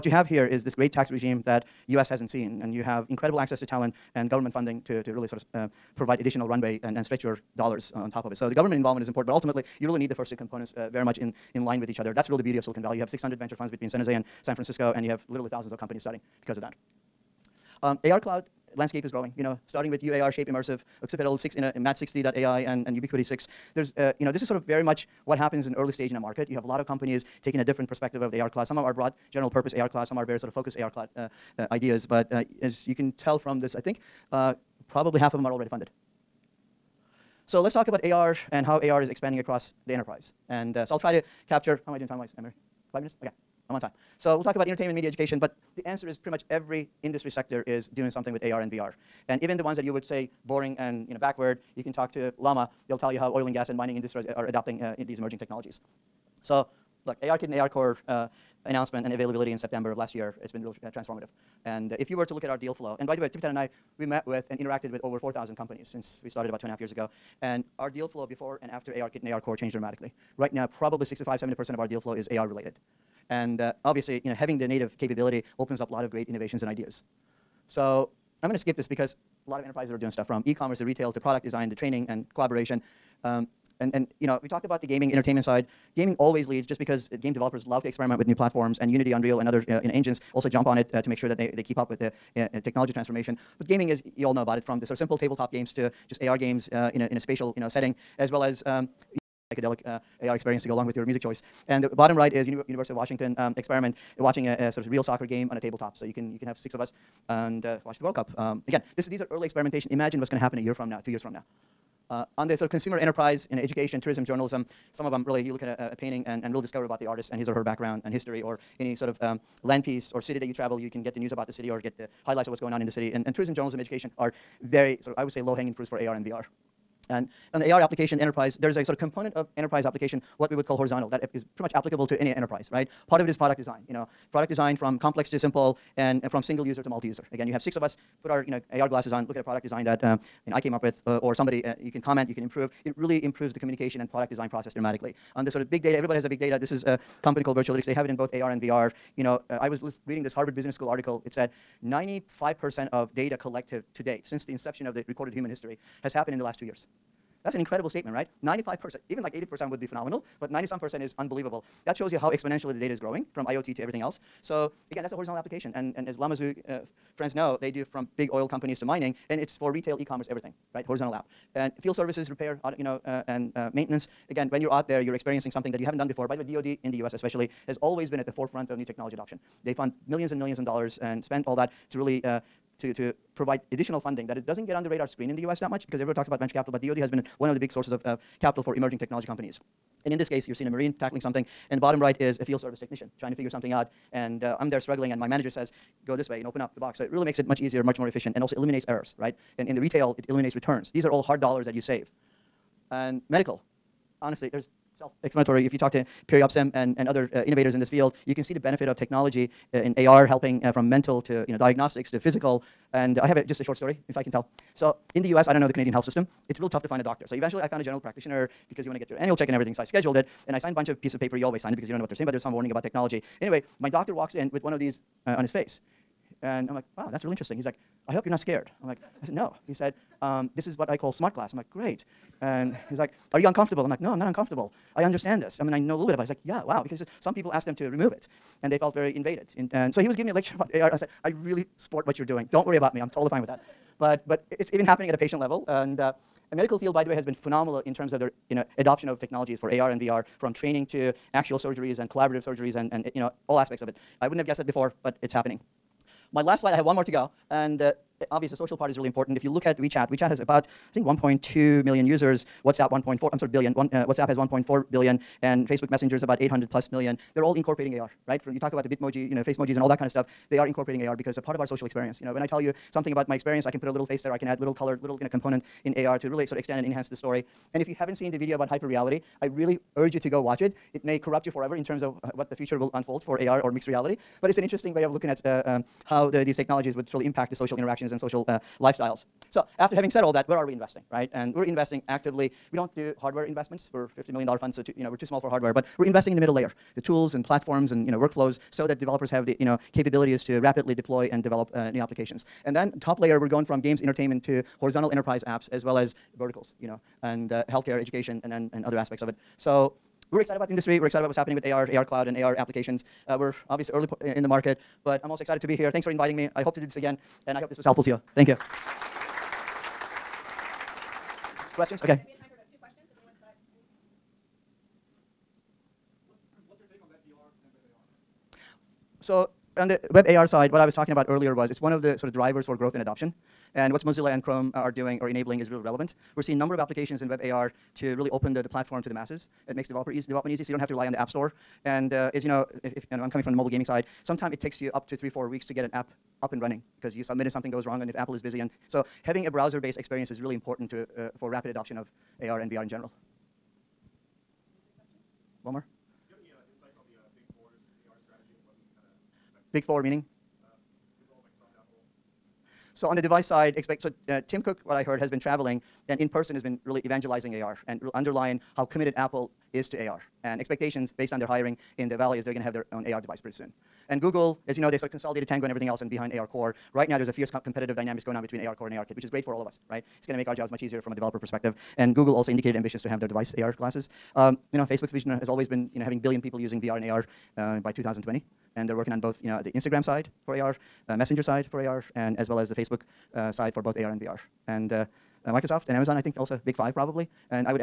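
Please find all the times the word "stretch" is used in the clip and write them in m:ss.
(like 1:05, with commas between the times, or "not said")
0:07.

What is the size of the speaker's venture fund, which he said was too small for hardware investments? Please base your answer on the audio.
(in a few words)
$50 million.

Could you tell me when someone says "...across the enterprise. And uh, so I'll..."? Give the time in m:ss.
0:39.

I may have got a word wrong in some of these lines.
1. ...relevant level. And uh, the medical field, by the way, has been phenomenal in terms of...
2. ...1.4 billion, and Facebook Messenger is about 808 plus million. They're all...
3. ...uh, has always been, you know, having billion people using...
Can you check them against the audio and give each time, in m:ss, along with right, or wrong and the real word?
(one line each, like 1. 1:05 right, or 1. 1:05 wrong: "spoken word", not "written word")
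1. 4:05 wrong: "patient", not "relevant"
2. 4:24 wrong: "800", not "808"
3. 6:25 right.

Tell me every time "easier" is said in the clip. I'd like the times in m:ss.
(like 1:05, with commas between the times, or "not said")
3:17, 6:20.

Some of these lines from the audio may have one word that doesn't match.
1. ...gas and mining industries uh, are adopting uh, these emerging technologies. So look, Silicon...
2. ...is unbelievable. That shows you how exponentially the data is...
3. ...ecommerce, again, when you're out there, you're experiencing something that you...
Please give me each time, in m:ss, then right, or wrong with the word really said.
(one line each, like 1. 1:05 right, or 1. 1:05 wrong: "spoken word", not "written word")
1. 0:53 wrong: "ARKit", not "Silicon"
2. 2:41 right
3. 2:53 wrong: "maintenance", not "ecommerce".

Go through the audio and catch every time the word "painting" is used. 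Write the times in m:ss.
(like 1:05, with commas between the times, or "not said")
1:55.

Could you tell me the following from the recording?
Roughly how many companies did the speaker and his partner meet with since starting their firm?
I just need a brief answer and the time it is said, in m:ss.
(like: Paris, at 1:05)
over 4,000, at 1:05.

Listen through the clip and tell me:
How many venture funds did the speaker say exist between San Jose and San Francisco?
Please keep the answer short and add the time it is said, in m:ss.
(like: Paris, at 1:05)
600, at 0:13.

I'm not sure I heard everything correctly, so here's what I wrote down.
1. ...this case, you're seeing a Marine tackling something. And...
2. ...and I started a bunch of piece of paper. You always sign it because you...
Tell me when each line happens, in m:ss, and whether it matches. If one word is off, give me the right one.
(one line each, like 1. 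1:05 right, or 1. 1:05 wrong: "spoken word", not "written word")
1. 3:10 right
2. 3:40 wrong: "signed", not "started".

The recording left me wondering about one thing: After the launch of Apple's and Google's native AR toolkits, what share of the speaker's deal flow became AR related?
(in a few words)
65 to 70%.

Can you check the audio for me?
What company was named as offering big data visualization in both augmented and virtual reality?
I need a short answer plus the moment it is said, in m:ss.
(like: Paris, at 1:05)
Virtualytics, at 2:27.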